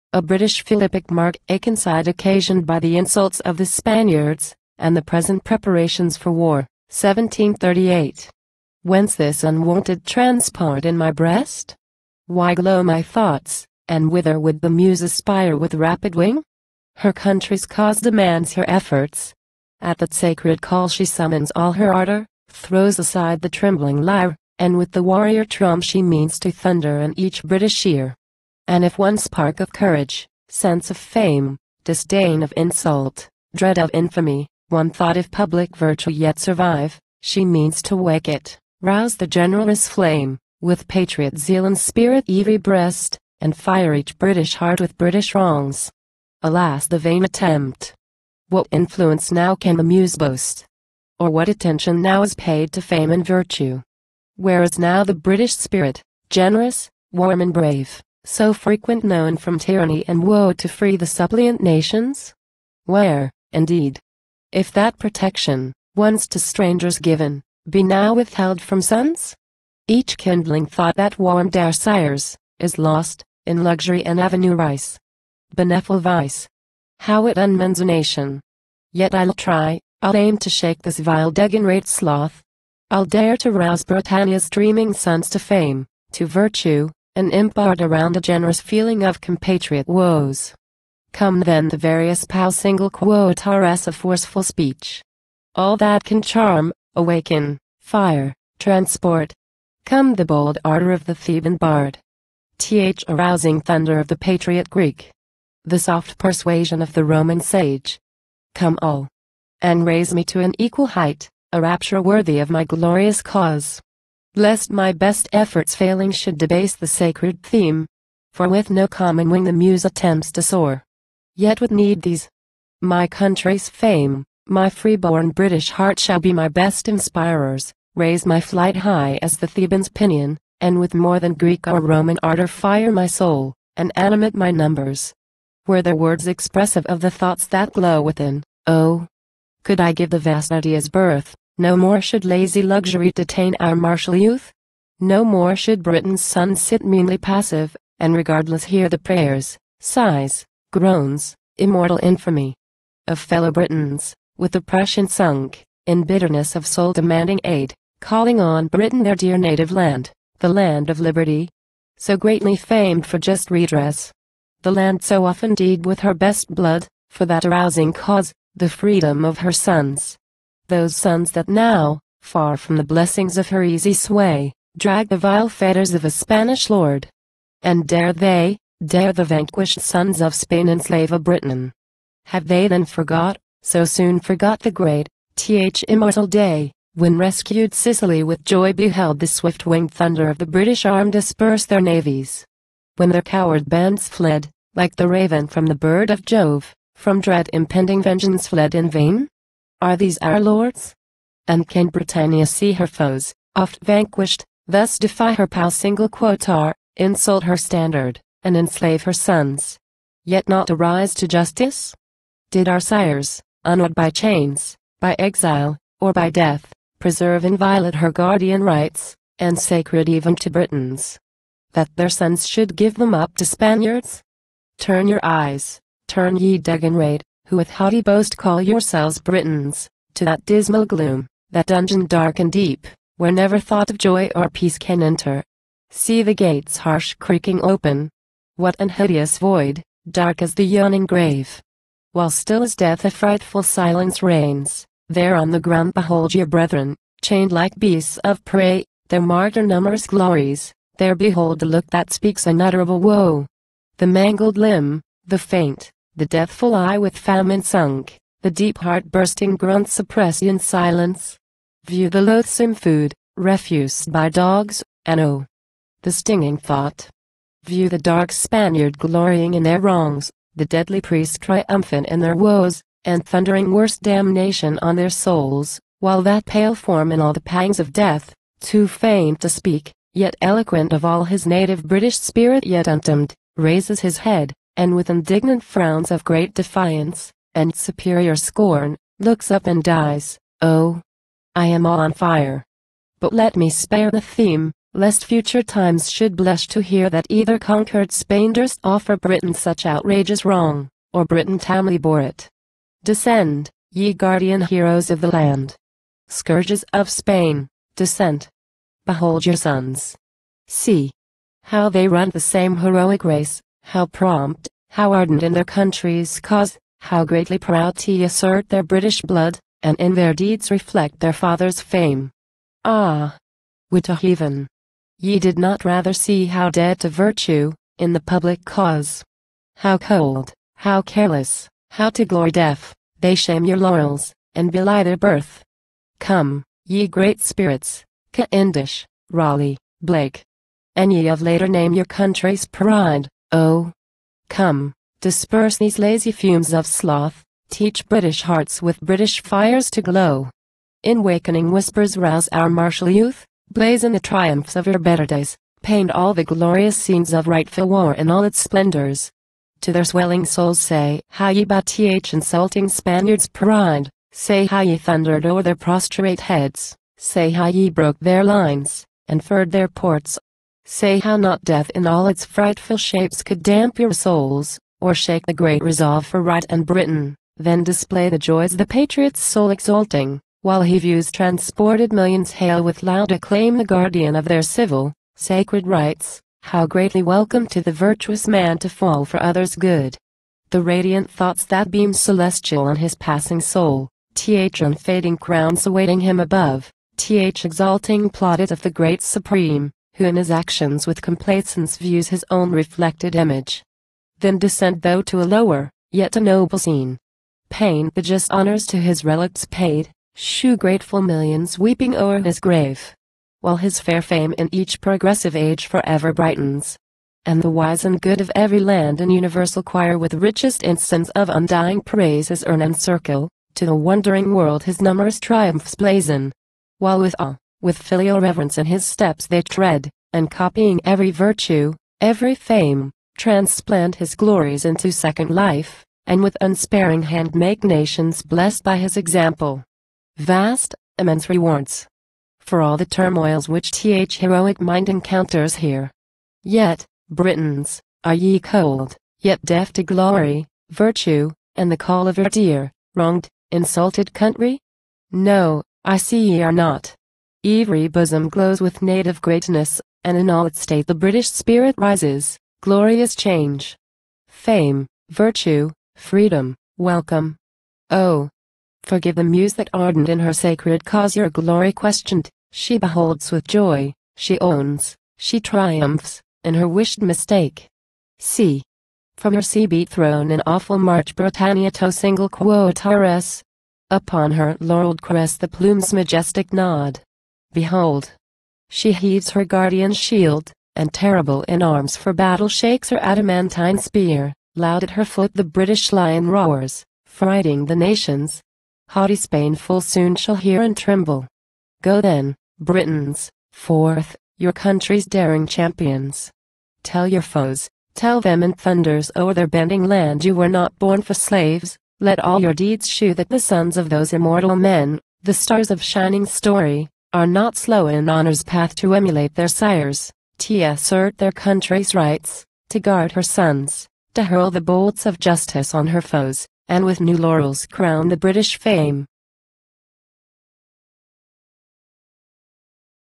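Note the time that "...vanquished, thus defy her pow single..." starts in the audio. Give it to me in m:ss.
3:23.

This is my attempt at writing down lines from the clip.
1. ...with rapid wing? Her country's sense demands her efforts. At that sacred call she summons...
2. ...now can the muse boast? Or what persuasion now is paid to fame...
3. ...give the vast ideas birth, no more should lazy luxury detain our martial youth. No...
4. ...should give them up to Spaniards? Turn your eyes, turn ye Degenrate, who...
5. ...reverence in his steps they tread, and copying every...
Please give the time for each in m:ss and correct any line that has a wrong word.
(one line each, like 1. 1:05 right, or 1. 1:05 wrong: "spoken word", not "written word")
1. 0:15 wrong: "cause", not "sense"
2. 0:49 wrong: "attention", not "persuasion"
3. 2:19 right
4. 3:42 right
5. 7:08 right.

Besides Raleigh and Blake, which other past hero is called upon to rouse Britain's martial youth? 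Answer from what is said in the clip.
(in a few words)
Cavendish.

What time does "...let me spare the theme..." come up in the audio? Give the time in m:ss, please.
4:53.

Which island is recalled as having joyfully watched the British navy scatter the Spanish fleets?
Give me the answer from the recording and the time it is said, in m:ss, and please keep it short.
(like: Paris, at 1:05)
Sicily, at 3:07.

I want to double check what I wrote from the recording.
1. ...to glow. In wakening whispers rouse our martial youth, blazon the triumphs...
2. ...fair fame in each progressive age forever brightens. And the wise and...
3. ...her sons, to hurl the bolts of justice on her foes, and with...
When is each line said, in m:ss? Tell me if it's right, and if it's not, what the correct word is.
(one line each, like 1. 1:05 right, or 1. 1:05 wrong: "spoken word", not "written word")
1. 5:49 right
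2. 6:53 right
3. 8:43 right.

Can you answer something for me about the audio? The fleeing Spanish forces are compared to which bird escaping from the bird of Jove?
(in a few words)
the raven.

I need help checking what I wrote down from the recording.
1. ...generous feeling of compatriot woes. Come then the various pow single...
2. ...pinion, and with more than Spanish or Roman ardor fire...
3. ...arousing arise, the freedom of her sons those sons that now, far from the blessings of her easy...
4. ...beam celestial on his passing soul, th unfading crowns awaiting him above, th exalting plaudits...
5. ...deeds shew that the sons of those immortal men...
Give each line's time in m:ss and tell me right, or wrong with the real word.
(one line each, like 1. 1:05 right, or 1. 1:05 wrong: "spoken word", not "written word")
1. 1:28 right
2. 2:09 wrong: "Greek", not "Spanish"
3. 2:47 wrong: "cause", not "arise"
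4. 6:31 right
5. 8:32 right.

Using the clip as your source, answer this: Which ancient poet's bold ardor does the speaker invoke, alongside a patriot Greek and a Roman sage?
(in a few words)
the Theban bard.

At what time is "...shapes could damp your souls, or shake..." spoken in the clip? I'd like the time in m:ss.
6:12.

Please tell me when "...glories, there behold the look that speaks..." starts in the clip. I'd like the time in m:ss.
4:10.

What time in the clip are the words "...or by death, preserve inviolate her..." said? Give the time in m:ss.
3:35.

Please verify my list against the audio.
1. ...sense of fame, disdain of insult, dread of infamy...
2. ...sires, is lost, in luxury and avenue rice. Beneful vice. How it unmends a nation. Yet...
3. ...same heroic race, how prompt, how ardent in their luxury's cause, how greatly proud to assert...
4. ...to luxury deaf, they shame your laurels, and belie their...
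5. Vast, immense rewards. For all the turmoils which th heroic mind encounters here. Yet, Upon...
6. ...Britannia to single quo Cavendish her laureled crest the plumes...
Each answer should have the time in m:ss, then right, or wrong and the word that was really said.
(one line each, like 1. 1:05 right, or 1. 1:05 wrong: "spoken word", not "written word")
1. 0:30 right
2. 1:11 right
3. 5:12 wrong: "country", not "luxury"
4. 5:32 wrong: "glory", not "luxury"
5. 7:20 wrong: "Britons", not "Upon"
6. 8:01 wrong: "Upon", not "Cavendish".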